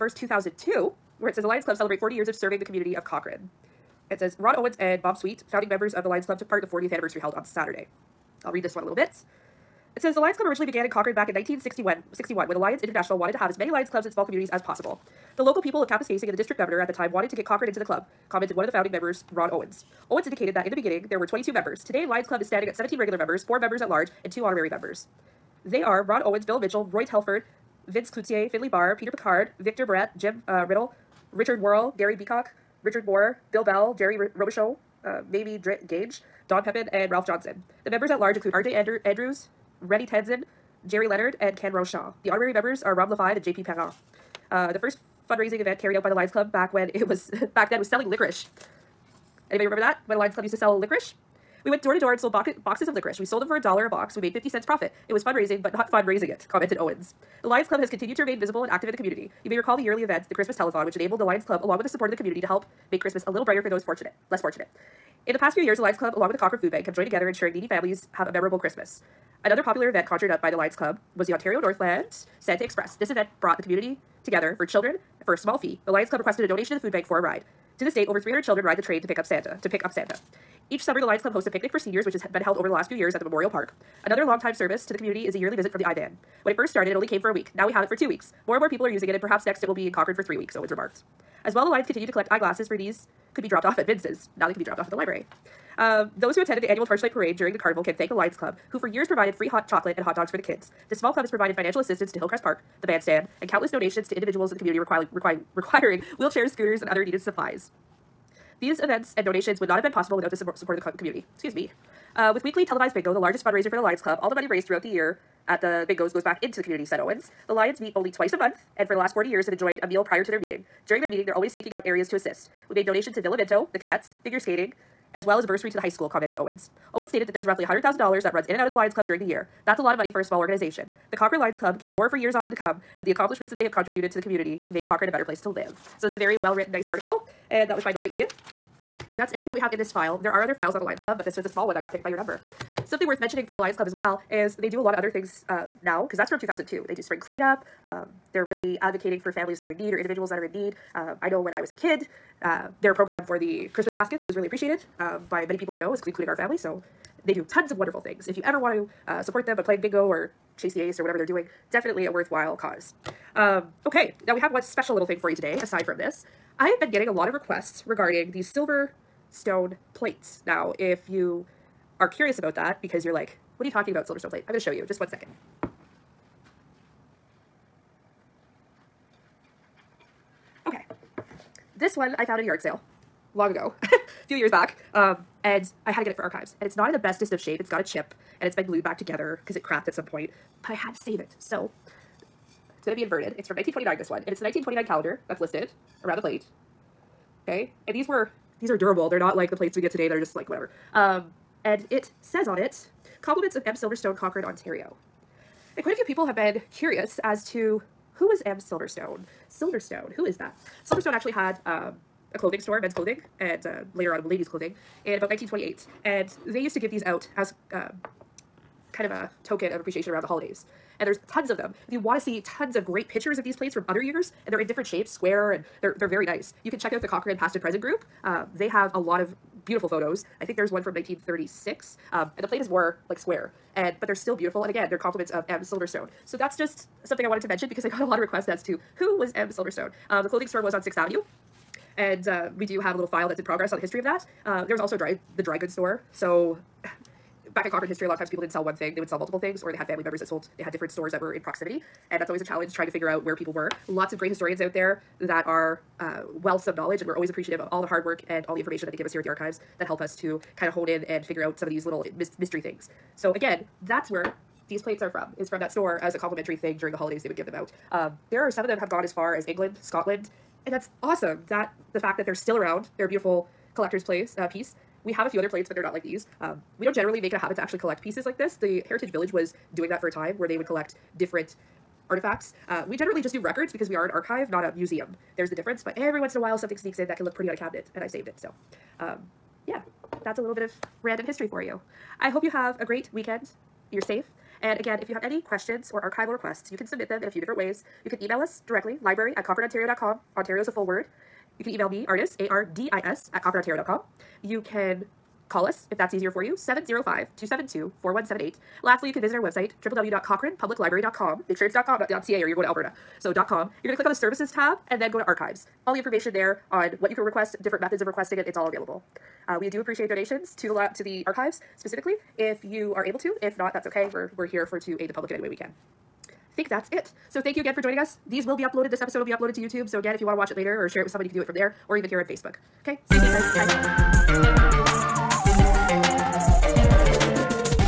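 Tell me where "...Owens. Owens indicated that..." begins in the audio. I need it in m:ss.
0:19.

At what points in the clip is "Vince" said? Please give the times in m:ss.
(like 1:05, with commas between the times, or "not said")
0:27, 1:33.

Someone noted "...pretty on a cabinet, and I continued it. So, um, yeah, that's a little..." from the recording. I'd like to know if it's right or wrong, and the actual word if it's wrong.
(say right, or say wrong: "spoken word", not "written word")
wrong: "saved", not "continued".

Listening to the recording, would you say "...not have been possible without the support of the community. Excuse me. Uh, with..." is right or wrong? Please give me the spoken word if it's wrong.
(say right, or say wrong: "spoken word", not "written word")
right.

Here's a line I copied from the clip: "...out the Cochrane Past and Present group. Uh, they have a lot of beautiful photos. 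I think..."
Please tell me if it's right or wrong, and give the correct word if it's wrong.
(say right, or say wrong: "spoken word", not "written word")
right.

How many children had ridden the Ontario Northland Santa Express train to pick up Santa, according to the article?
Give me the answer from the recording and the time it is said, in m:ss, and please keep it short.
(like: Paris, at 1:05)
Over 300, at 1:18.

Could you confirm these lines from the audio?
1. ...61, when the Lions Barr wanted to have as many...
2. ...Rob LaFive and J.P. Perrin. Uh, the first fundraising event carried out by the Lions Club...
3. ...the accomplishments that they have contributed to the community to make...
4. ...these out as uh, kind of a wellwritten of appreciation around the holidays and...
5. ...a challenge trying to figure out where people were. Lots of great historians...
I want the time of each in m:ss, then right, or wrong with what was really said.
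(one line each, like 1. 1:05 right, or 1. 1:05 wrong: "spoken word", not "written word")
1. 0:12 wrong: "International", not "Barr"
2. 0:42 right
3. 2:13 right
4. 3:36 wrong: "token", not "wellwritten"
5. 4:12 right.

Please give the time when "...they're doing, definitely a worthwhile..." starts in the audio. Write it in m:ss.
2:41.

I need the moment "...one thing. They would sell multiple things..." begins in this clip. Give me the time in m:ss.
4:08.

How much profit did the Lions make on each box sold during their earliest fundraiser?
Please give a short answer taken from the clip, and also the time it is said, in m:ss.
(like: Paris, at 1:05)
50 cents, at 0:54.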